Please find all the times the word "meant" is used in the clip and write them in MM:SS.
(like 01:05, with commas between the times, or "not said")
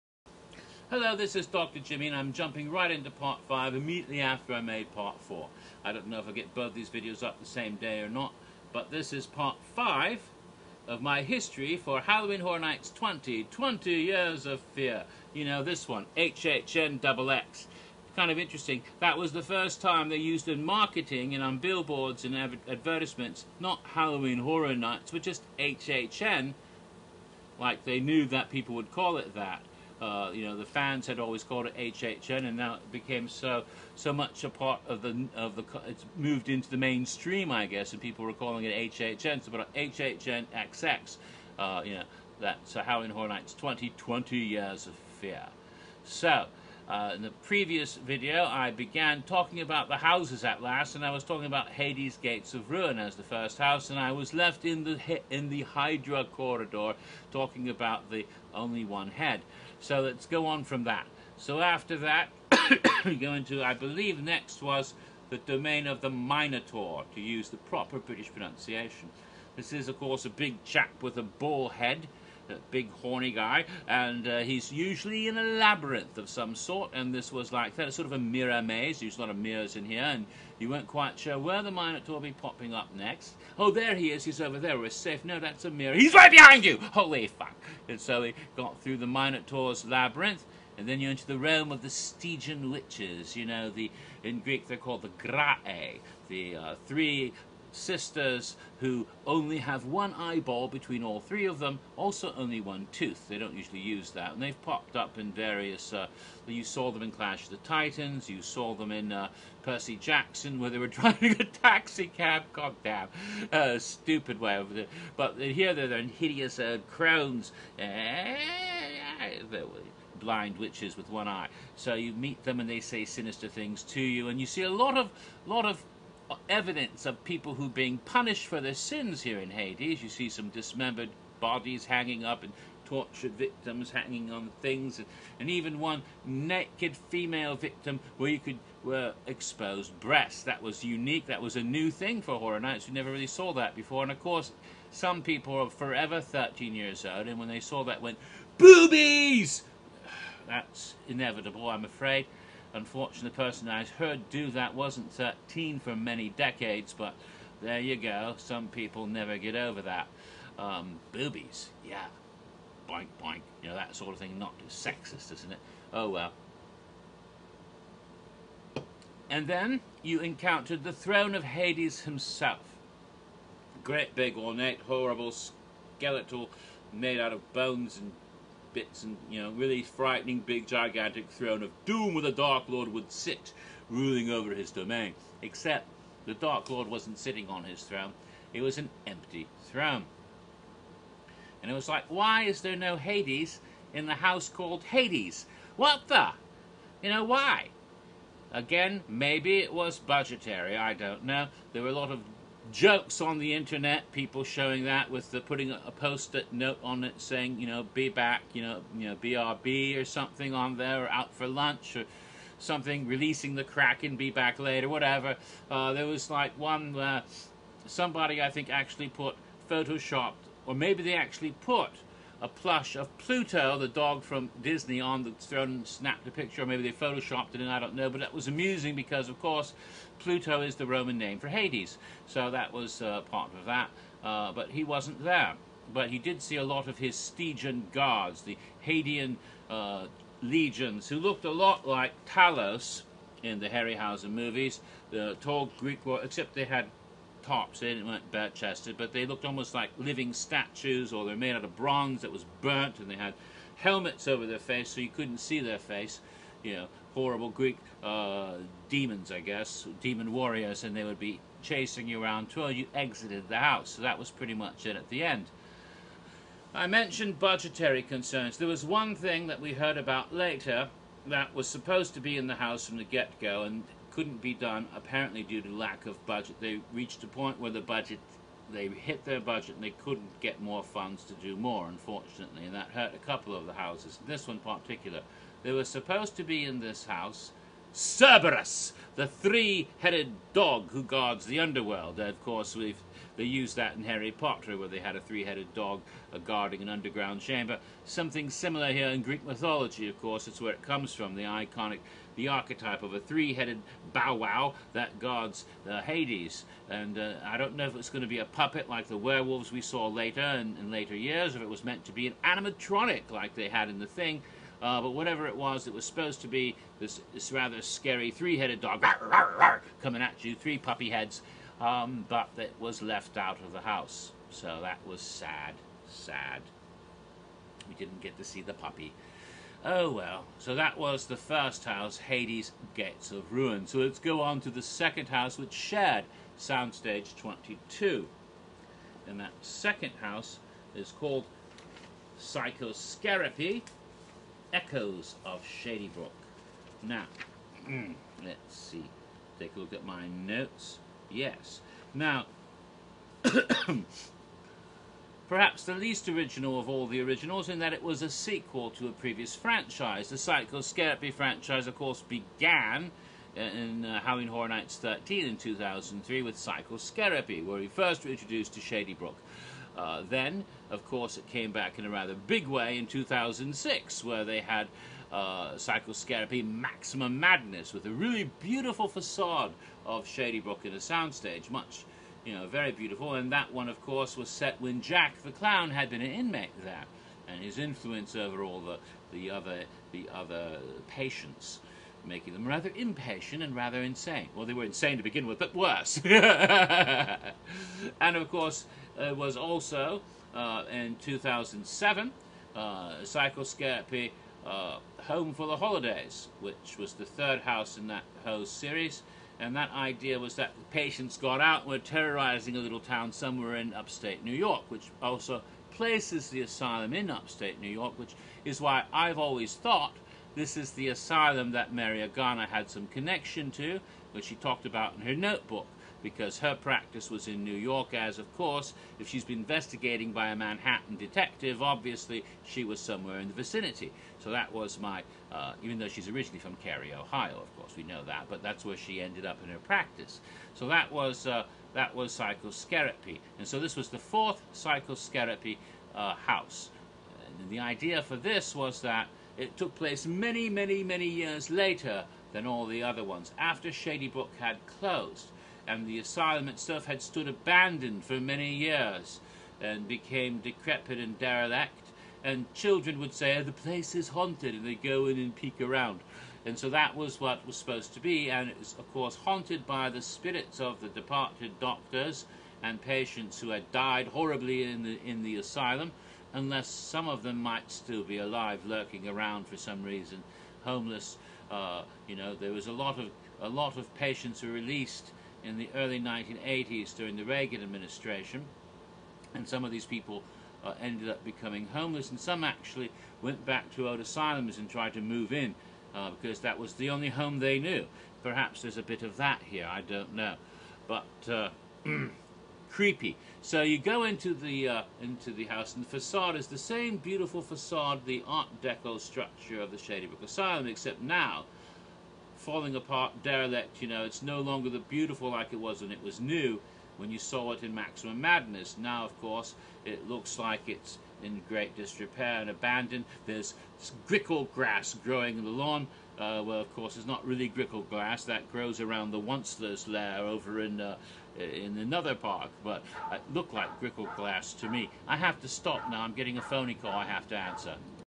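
05:11.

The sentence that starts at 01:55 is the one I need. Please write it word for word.
But here they're in hideous uh, crowns, eh, blind witches with one eye.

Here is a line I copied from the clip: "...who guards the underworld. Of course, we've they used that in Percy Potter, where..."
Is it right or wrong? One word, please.
wrong.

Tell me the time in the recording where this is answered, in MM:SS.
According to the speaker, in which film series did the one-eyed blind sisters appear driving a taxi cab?
01:49.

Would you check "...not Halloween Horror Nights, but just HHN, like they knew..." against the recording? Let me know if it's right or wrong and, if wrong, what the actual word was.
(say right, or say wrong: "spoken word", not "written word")
right.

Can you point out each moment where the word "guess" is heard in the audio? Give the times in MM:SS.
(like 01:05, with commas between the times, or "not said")
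00:37, 04:19.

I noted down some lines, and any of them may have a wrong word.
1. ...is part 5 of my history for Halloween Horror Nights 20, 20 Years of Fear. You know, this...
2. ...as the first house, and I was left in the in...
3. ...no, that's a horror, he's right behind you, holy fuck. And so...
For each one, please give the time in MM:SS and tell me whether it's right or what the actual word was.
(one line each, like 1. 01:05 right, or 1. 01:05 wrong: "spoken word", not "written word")
1. 00:09 right
2. 00:52 right
3. 01:25 wrong: "mirror", not "horror".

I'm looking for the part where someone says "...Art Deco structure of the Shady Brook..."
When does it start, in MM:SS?
08:28.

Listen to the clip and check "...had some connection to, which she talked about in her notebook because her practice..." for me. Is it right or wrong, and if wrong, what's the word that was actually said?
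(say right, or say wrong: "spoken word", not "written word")
right.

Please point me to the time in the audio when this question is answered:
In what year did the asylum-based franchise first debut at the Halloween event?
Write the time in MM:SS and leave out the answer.
06:05.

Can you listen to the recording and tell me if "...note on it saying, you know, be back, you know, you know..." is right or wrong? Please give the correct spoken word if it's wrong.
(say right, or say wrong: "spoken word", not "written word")
right.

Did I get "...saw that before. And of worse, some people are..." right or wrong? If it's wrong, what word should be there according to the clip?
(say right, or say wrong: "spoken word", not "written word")
wrong: "course", not "worse".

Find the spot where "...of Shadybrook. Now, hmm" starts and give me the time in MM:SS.
05:45.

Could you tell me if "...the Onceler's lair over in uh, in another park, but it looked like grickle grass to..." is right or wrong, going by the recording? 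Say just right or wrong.
right.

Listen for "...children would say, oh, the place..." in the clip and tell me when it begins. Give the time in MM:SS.
07:42.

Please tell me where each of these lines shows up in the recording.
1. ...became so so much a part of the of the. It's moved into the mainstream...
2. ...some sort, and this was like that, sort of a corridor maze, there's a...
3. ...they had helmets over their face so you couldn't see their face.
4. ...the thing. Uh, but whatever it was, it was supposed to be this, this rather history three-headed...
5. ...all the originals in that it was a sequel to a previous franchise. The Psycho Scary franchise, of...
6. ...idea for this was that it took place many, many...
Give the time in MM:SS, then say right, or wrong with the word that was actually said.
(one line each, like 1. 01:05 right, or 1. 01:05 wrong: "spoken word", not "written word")
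1. 00:32 right
2. 01:16 wrong: "mirror", not "corridor"
3. 04:13 right
4. 05:13 wrong: "scary", not "history"
5. 05:56 right
6. 07:27 right.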